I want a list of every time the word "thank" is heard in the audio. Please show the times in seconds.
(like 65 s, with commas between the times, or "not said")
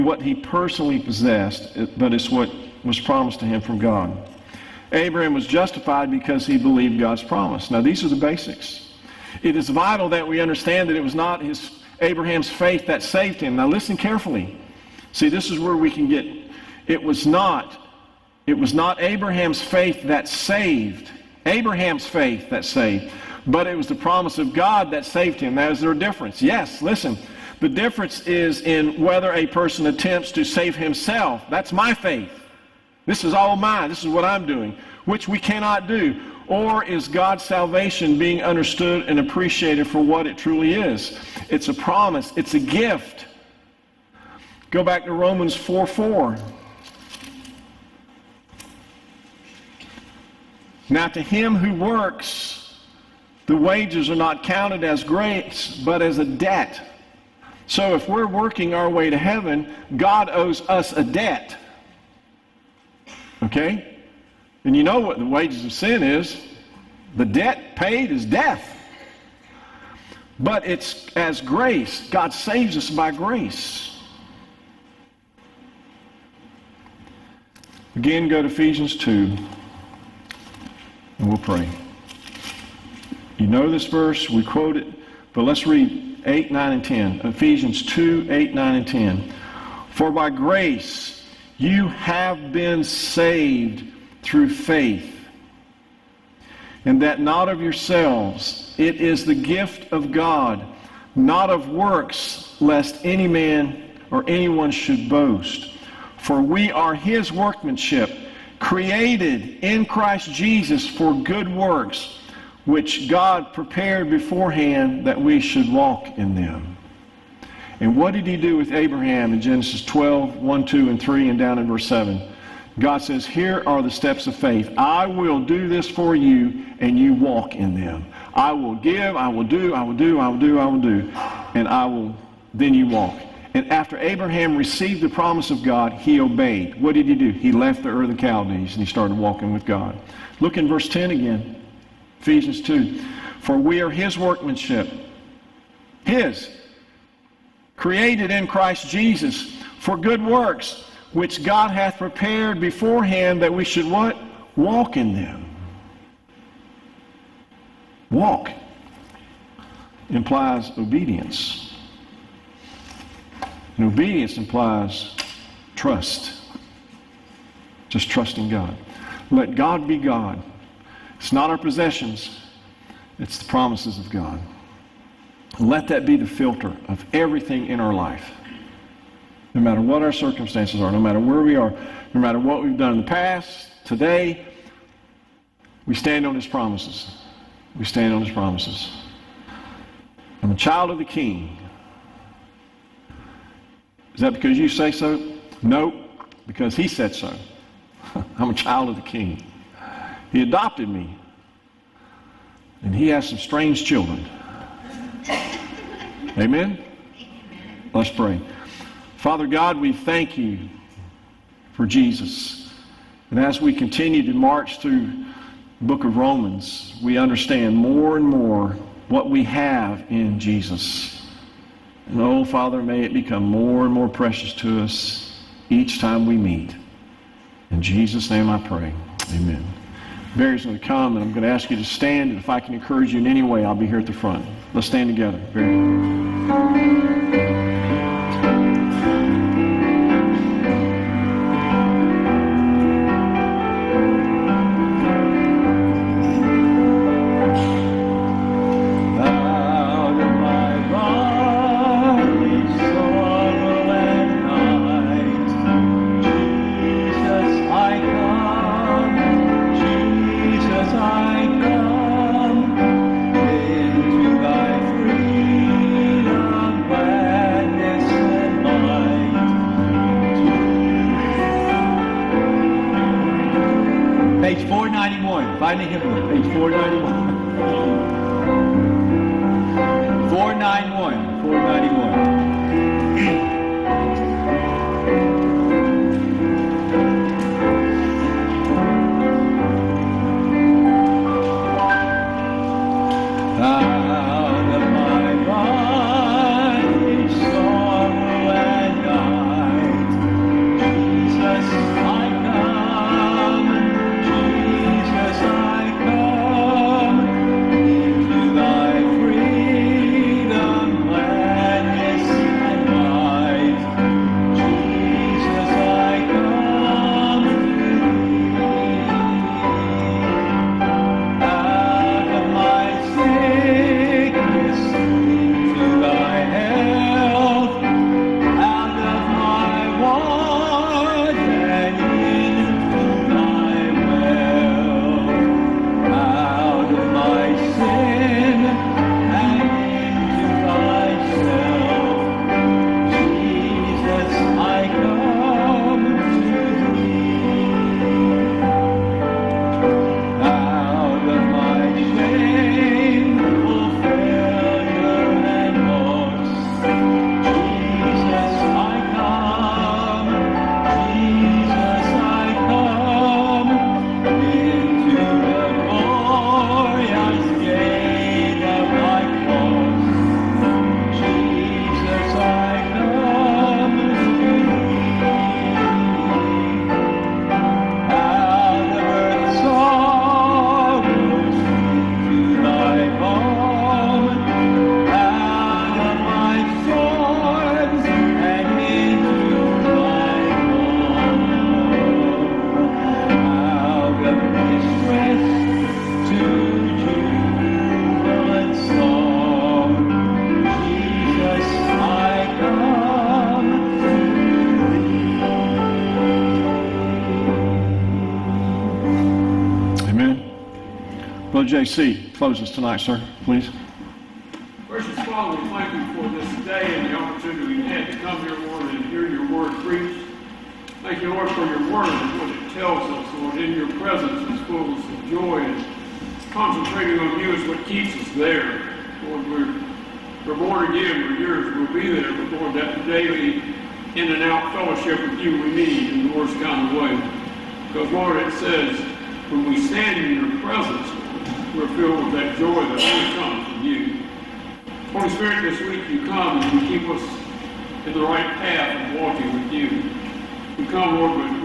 209 s, 415 s, 421 s.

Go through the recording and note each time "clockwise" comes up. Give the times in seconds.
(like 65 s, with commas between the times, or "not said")
not said.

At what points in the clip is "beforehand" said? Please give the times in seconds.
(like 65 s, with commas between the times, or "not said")
114 s, 152 s.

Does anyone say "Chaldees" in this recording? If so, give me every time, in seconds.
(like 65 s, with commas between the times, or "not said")
138 s.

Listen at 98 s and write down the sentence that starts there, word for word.
It is the gift of God, not of works, lest any man or anyone should boast.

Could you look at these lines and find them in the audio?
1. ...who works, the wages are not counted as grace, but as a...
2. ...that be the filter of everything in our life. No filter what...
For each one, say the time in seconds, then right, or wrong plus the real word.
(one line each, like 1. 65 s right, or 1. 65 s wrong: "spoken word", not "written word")
1. 51 s right
2. 175 s wrong: "matter", not "filter".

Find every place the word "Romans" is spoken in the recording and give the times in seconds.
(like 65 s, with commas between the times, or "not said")
45 s, 216 s.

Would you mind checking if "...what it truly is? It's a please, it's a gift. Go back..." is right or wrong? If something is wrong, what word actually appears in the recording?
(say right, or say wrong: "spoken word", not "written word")
wrong: "promise", not "please".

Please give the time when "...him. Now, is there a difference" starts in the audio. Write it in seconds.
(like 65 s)
25 s.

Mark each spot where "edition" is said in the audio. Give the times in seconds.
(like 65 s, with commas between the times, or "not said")
not said.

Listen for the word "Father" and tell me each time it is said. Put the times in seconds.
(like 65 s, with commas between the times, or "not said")
209 s, 222 s, 415 s.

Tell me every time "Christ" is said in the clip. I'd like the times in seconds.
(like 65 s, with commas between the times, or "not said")
109 s, 148 s.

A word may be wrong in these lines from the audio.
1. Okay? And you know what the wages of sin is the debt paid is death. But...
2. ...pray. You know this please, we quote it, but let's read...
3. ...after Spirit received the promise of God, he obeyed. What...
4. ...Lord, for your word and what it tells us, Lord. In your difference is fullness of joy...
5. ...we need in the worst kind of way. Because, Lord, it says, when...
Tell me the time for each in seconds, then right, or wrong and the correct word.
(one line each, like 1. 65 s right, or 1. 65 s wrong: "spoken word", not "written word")
1. 63 s right
2. 81 s wrong: "verse", not "please"
3. 133 s wrong: "Abraham", not "Spirit"
4. 421 s wrong: "presence", not "difference"
5. 435 s right.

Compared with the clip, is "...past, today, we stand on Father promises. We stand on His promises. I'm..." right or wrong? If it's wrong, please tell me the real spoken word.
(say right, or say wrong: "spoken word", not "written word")
wrong: "His", not "Father".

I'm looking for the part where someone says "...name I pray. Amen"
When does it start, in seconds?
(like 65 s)
228 s.